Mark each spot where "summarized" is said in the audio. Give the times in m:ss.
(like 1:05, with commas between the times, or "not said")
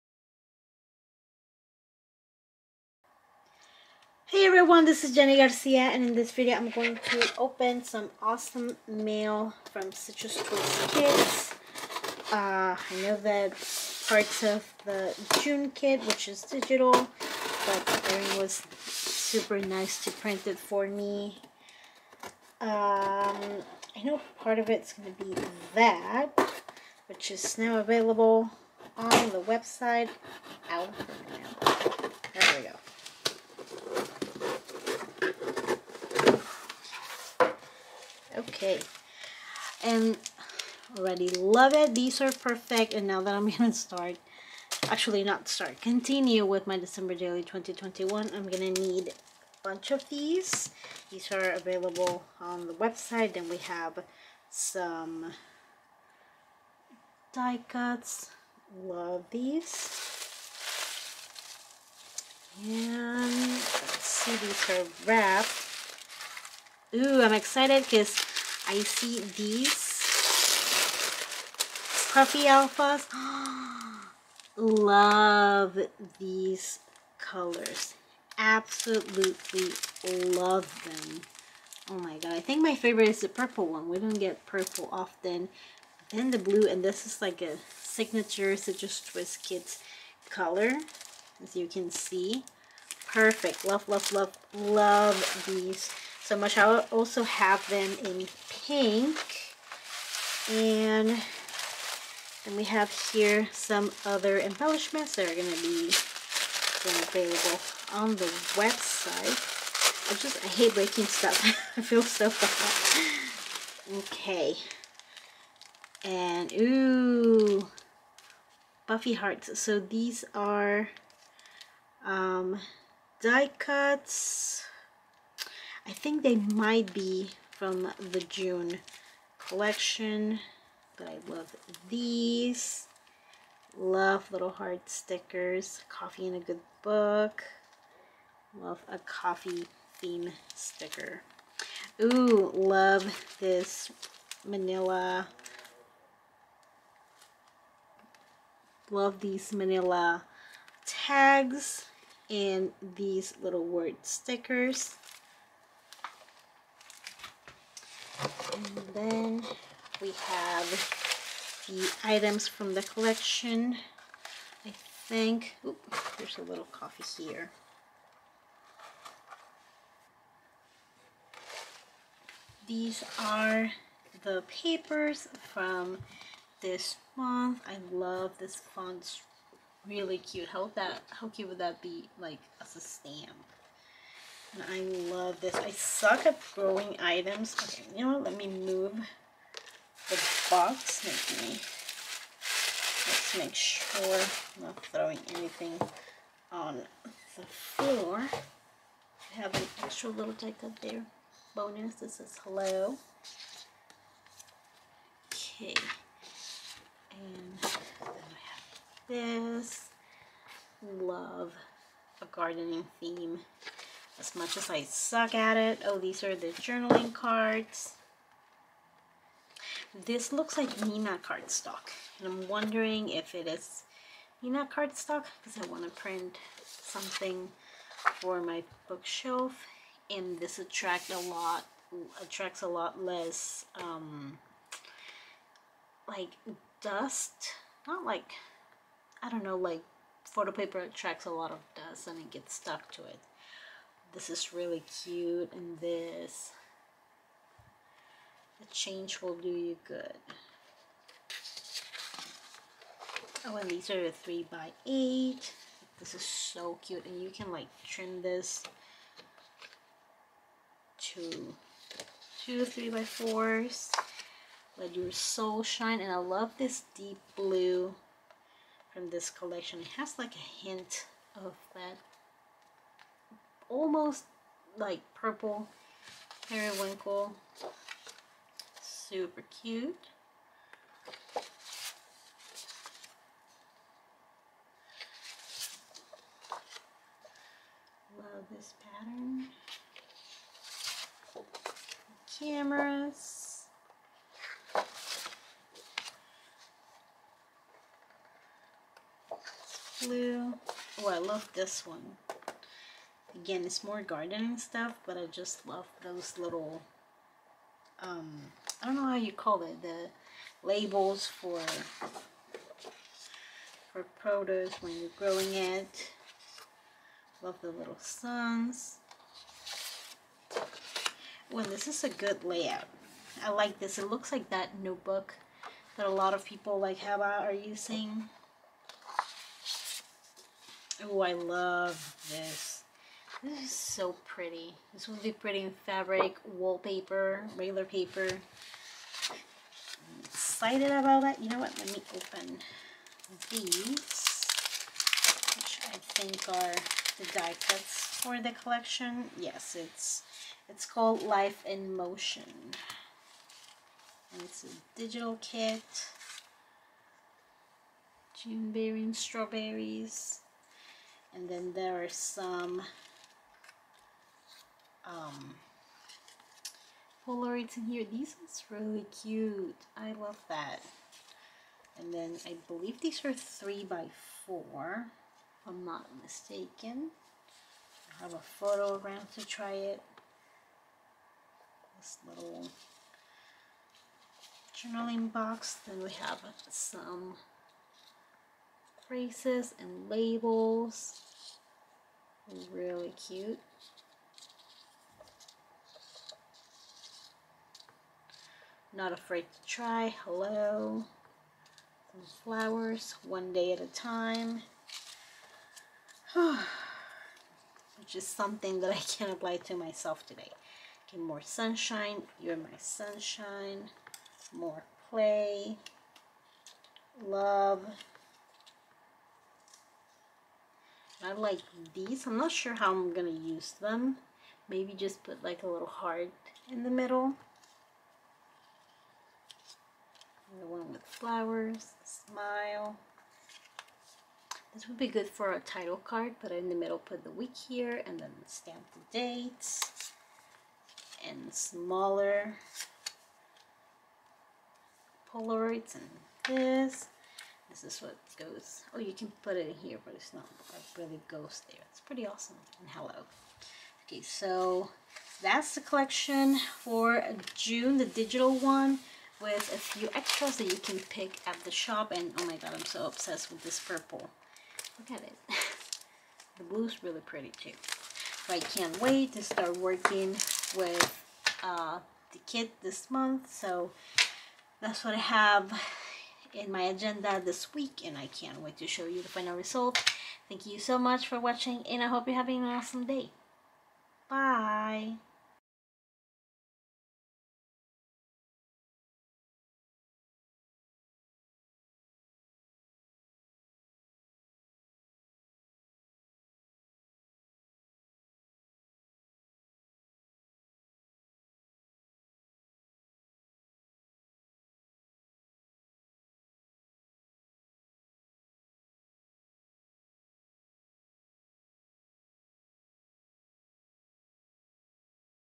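not said.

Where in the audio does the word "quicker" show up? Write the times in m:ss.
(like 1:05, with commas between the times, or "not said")
not said.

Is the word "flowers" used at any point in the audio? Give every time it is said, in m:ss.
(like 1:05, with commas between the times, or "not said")
6:42, 7:11.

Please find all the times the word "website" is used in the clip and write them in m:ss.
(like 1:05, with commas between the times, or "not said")
0:29, 0:52, 1:48.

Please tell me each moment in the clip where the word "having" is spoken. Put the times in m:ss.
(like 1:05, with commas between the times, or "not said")
8:02.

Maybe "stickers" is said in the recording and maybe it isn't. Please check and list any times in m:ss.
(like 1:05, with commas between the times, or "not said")
2:14, 2:20, 2:34.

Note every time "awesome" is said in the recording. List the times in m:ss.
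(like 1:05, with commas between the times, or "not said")
0:08, 7:32, 8:02.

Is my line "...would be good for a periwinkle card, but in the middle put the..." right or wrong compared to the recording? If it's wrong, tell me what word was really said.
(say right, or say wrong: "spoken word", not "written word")
wrong: "title", not "periwinkle".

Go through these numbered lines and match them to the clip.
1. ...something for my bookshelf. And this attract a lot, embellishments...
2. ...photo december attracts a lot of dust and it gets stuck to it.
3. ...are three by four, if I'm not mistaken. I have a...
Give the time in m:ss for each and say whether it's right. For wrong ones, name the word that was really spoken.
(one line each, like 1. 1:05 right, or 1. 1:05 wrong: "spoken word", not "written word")
1. 3:46 wrong: "attracts", not "embellishments"
2. 4:00 wrong: "paper", not "december"
3. 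6:13 right.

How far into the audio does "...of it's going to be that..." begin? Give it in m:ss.
0:24.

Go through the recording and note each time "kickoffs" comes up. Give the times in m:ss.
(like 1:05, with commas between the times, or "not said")
not said.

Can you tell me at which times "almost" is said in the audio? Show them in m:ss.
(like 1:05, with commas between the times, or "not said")
4:33.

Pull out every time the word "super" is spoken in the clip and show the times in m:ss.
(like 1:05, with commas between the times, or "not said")
0:18, 4:39.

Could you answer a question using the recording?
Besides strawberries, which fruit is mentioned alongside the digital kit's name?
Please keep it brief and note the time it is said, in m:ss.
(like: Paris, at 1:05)
June berry, at 5:58.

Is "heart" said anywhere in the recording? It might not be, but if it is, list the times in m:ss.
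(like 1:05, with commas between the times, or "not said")
1:59, 2:14, 7:05.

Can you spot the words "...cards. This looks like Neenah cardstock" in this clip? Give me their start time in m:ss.
3:37.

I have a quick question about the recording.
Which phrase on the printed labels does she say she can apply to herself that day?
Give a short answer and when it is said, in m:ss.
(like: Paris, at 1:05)
One day at a time, at 6:43.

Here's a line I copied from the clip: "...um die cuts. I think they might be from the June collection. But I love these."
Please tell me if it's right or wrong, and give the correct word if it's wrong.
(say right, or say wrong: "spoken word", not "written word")
right.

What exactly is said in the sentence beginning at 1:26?
Then the blue, and this is like a signature Citrus Twist kit color, as you can see.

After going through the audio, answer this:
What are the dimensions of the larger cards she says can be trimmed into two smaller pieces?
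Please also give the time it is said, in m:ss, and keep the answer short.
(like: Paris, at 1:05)
3 by 8, at 4:14.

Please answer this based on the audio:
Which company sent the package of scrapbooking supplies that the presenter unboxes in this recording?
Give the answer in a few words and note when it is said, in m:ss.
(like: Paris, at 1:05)
Citrus Twist Kits, at 0:09.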